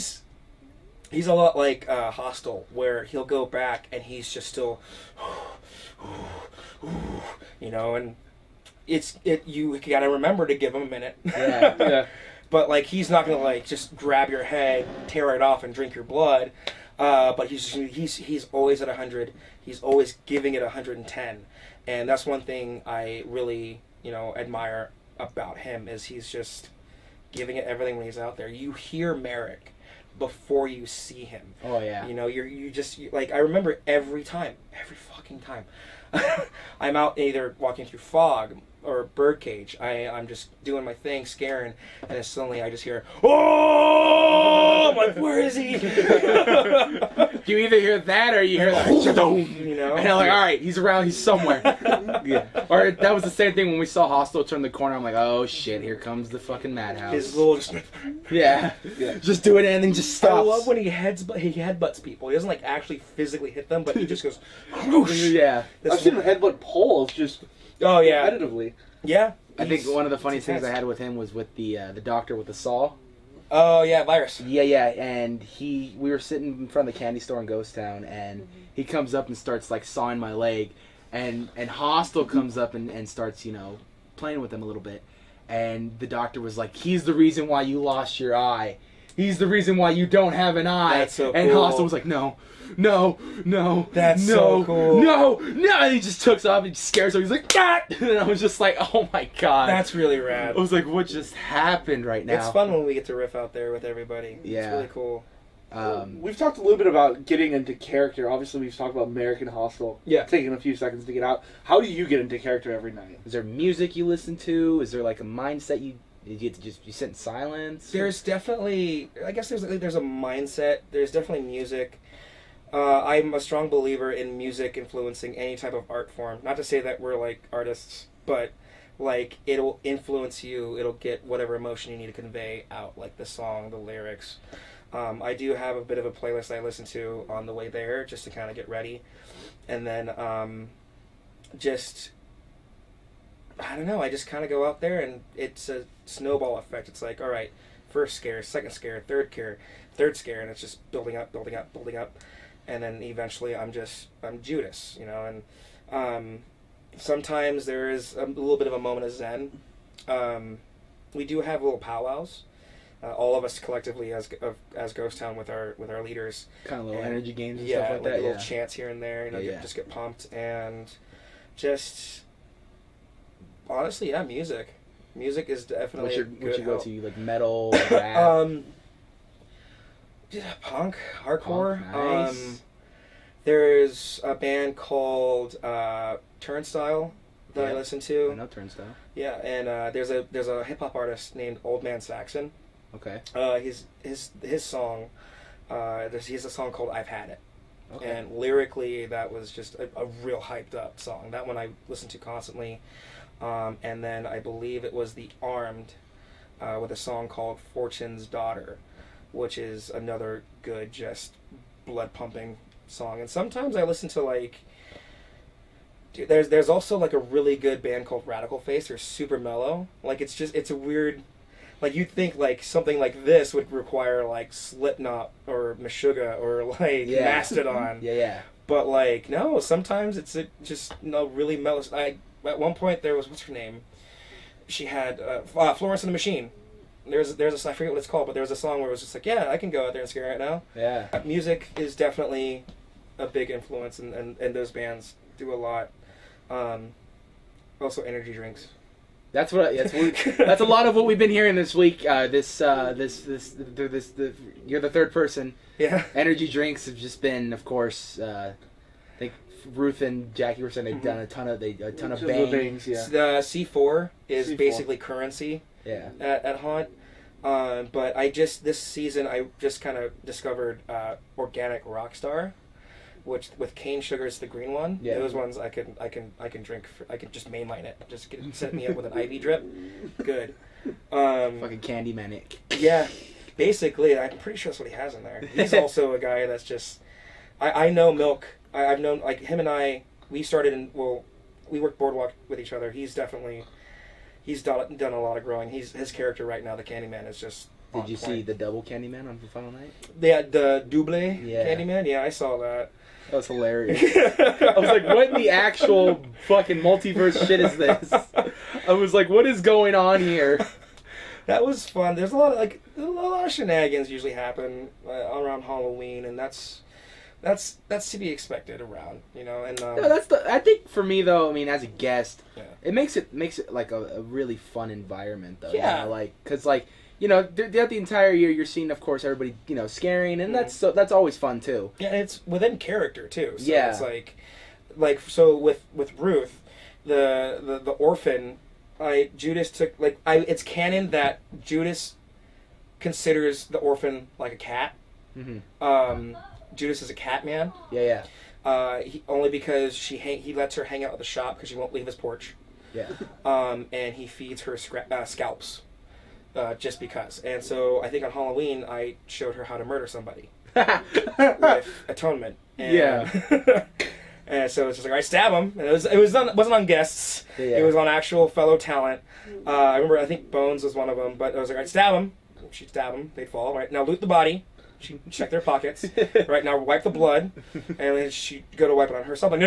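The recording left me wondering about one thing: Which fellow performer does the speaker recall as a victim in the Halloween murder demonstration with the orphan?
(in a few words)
Bones.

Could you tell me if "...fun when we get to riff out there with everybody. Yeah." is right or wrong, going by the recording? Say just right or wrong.
right.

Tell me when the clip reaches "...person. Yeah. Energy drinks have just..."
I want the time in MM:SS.
04:15.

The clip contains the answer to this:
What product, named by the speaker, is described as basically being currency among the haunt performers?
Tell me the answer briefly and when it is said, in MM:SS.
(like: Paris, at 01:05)
C4, at 04:24.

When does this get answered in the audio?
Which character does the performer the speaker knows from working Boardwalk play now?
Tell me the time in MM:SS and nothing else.
04:56.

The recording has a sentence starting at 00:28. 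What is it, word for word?
You hear Merrick before you see him.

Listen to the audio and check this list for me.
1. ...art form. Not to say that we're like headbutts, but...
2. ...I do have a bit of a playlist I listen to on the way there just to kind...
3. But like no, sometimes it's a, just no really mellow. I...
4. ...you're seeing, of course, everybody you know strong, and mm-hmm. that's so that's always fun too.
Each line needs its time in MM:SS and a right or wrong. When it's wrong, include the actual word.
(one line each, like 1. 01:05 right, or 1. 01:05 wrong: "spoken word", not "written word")
1. 02:05 wrong: "artists", not "headbutts"
2. 02:15 right
3. 03:48 right
4. 05:28 wrong: "scaring", not "strong".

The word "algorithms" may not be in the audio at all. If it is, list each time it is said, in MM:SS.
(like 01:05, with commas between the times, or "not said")
not said.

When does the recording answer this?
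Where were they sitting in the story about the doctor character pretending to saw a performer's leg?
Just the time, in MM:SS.
01:16.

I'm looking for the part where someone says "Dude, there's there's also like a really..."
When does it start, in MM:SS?
03:36.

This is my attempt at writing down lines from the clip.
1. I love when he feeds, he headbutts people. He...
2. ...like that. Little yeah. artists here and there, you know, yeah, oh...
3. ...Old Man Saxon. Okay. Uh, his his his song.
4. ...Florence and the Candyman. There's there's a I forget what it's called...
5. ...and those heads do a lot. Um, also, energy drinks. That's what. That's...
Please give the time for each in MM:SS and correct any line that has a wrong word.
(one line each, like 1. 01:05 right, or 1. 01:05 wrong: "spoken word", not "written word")
1. 01:00 wrong: "heads", not "feeds"
2. 02:48 wrong: "chants", not "artists"
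3. 03:11 right
4. 03:55 wrong: "Machine", not "Candyman"
5. 04:04 wrong: "bands", not "heads".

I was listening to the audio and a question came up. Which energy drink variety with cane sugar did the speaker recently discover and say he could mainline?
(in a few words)
organic rockstar.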